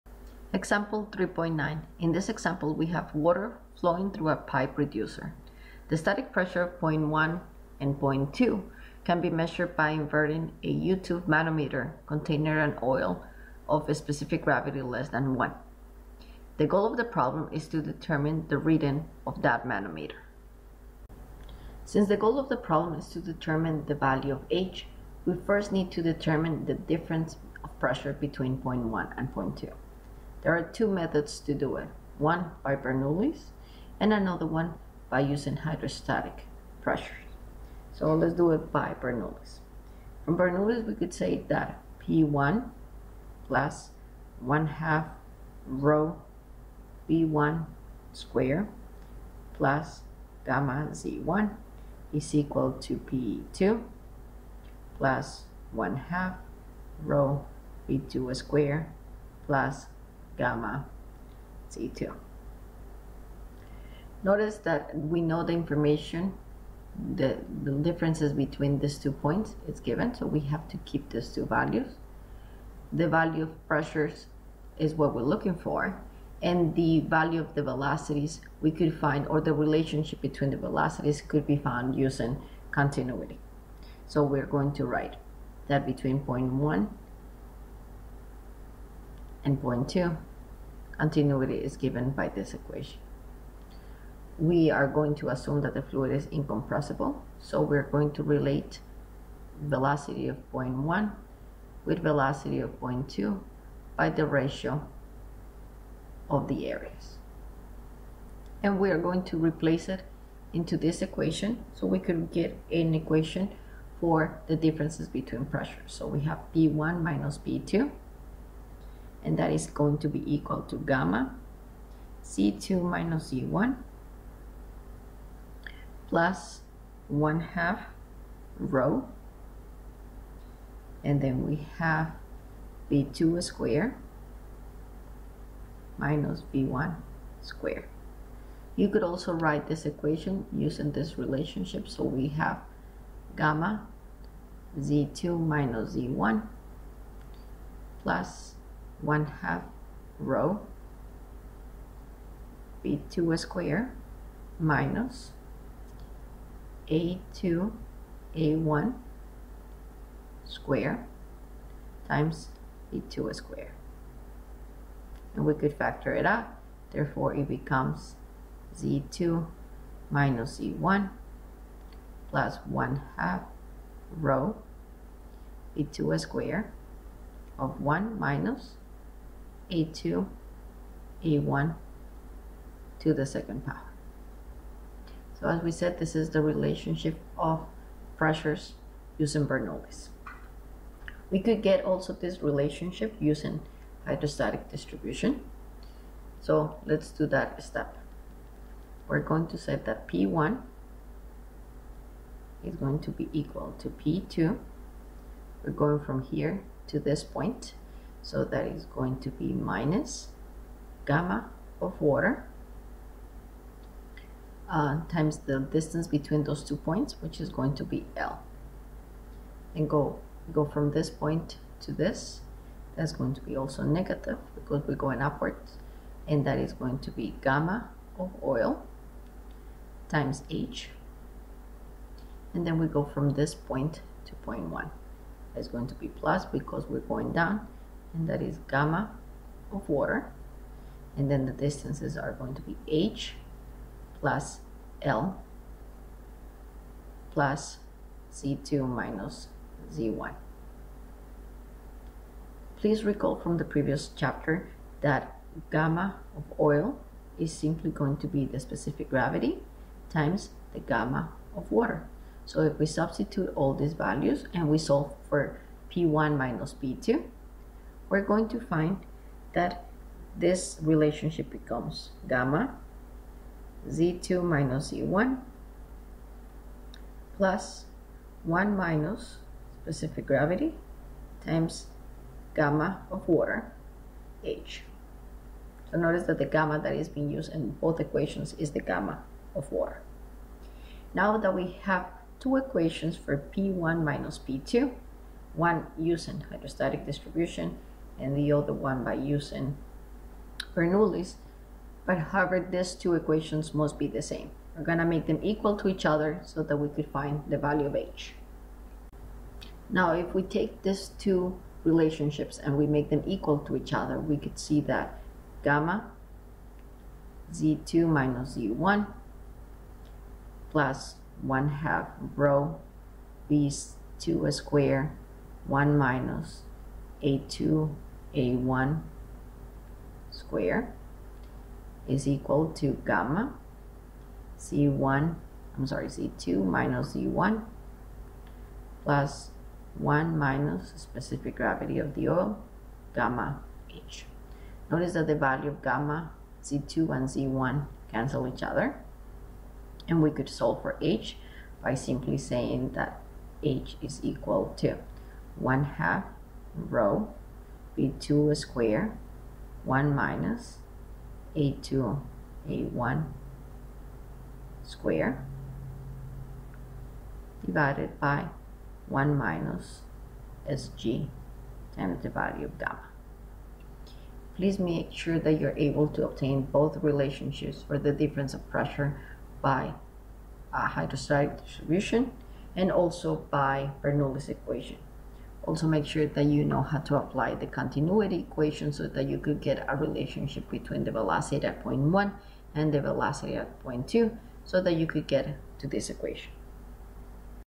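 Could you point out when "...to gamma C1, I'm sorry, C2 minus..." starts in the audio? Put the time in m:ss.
5:32.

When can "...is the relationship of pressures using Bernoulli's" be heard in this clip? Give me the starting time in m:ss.
3:06.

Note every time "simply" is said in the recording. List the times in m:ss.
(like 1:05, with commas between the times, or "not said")
4:17, 5:51.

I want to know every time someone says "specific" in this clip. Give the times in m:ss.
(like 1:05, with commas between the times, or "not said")
0:13, 4:18, 4:39, 5:40.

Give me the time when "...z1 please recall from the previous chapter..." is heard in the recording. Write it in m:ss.
4:09.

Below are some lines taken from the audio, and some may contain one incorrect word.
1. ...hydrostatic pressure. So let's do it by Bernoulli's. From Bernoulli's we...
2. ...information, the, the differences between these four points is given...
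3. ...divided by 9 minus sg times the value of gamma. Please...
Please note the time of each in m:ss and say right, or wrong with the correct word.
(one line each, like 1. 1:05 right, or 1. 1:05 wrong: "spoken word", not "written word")
1. 0:35 right
2. 1:05 wrong: "two", not "four"
3. 6:07 wrong: "1", not "9".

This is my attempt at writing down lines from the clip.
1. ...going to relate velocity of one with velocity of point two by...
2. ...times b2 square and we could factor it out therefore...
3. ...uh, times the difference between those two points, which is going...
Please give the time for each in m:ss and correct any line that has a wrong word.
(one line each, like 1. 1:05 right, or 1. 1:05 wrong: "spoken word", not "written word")
1. 1:37 right
2. 2:42 right
3. 3:34 wrong: "distance", not "difference".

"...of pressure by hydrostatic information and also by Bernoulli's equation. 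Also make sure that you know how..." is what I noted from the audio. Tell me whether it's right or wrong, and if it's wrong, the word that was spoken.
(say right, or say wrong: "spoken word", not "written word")
wrong: "distribution", not "information".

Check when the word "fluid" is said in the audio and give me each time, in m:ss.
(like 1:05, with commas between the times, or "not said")
1:35.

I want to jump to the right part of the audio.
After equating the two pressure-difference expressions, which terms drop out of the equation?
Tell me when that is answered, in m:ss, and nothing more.
5:45.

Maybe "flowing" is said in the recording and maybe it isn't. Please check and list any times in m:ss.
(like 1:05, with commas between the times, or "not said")
0:03.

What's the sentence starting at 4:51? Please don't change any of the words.
Now that we have two equations for P1 minus P2, one using hydrostatic distribution and the other one by using Bernoulli's.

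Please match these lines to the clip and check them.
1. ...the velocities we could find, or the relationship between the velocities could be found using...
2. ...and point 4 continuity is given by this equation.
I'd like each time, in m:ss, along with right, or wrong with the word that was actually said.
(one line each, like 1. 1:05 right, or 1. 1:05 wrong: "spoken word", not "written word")
1. 1:17 right
2. 1:29 wrong: "2", not "4".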